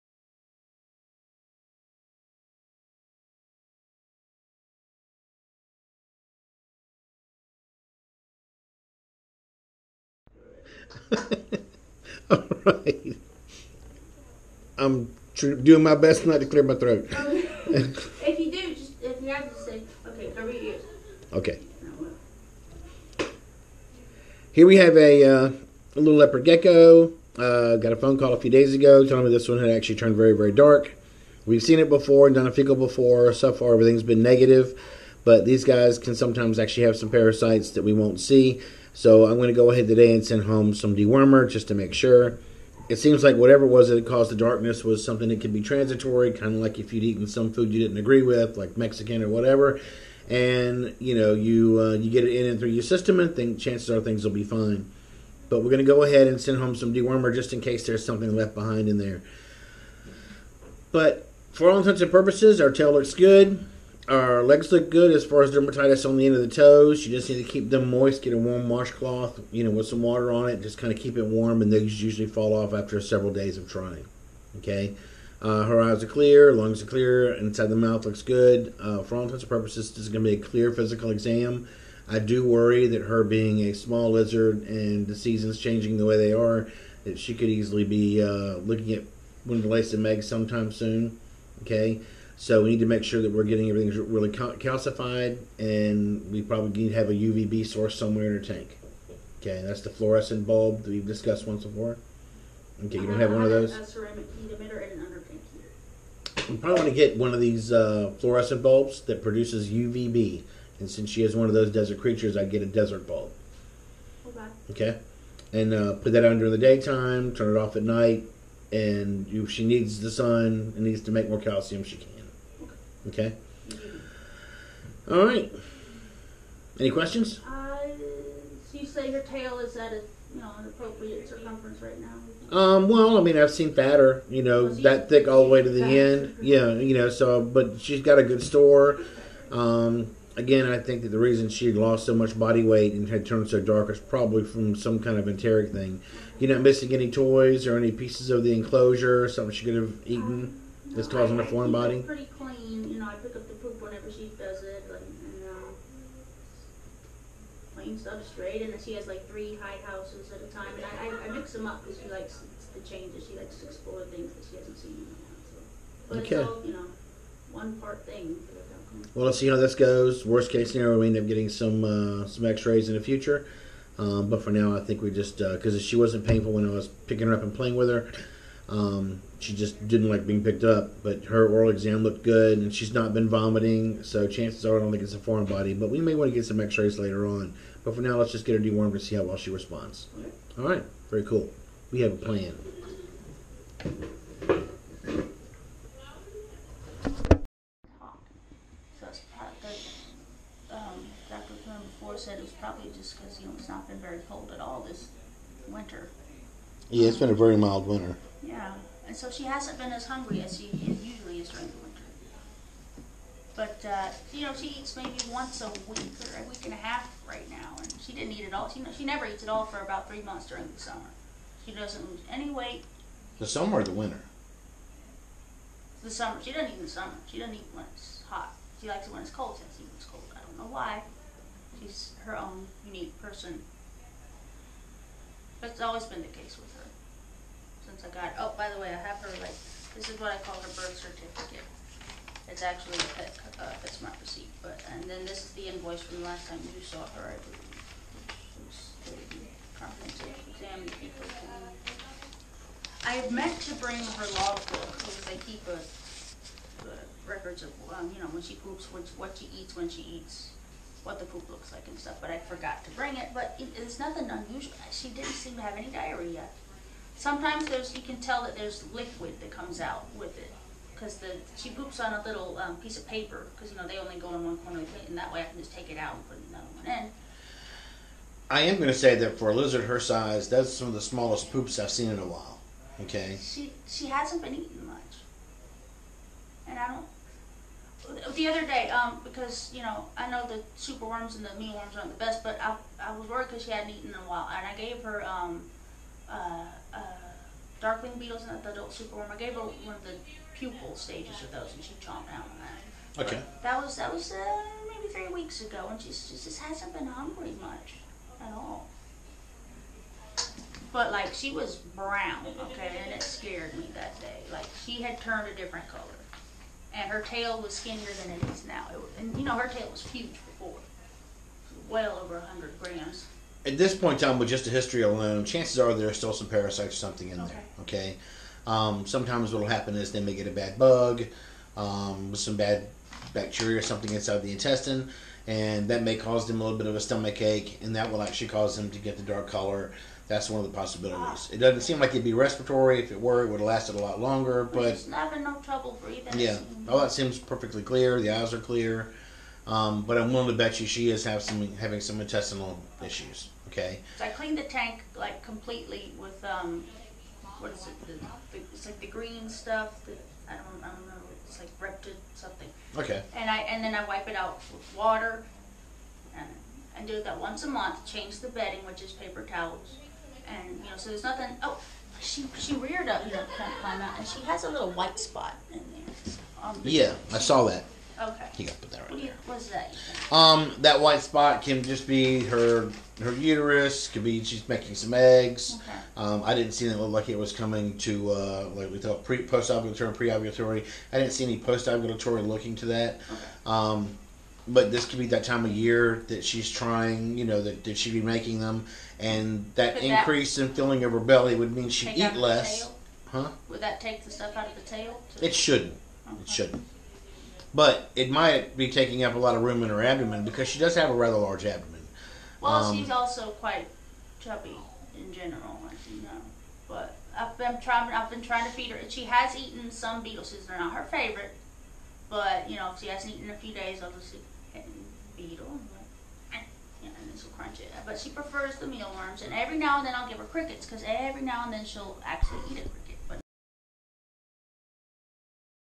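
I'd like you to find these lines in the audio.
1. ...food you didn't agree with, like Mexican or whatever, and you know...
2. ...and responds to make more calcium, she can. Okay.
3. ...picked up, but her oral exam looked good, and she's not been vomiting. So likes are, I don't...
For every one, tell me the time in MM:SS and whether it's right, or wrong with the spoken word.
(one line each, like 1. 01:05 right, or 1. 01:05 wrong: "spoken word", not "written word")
1. 00:47 right
2. 02:00 wrong: "needs", not "responds"
3. 03:00 wrong: "chances", not "likes".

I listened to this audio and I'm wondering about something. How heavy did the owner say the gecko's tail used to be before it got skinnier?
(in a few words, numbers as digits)
over 100 grams.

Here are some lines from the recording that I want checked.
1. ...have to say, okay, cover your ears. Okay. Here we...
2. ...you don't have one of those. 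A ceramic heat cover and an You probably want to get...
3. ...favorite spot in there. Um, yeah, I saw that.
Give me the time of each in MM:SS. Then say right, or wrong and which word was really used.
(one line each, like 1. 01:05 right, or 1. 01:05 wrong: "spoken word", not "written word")
1. 00:19 right
2. 01:42 wrong: "emitter", not "cover"
3. 06:14 wrong: "white", not "favorite".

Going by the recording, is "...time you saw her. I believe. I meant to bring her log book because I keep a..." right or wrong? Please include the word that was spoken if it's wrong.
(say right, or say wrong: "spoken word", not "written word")
right.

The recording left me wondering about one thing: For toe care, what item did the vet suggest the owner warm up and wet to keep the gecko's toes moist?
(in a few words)
warm washcloth.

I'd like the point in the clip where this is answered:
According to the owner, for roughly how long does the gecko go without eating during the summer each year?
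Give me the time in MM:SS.
03:40.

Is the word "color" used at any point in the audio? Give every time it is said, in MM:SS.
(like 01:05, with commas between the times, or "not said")
05:15, 05:39.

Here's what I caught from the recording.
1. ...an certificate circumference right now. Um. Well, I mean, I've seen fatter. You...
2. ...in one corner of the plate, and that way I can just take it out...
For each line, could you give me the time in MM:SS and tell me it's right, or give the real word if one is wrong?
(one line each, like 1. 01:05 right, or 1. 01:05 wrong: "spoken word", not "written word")
1. 02:10 wrong: "appropriate", not "certificate"
2. 04:34 right.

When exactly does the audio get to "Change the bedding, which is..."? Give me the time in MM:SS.
06:08.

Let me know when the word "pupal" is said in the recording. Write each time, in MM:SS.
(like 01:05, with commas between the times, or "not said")
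05:00.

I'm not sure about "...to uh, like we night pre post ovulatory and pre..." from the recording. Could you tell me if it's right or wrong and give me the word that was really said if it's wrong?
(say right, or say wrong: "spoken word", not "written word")
wrong: "thought", not "night".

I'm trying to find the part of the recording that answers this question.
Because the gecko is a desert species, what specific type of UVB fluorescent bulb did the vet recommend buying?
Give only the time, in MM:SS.
01:52.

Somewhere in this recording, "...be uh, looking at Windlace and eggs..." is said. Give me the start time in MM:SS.
01:27.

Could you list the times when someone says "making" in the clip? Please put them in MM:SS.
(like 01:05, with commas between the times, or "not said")
06:24, 06:38.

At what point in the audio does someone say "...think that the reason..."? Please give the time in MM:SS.
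02:20.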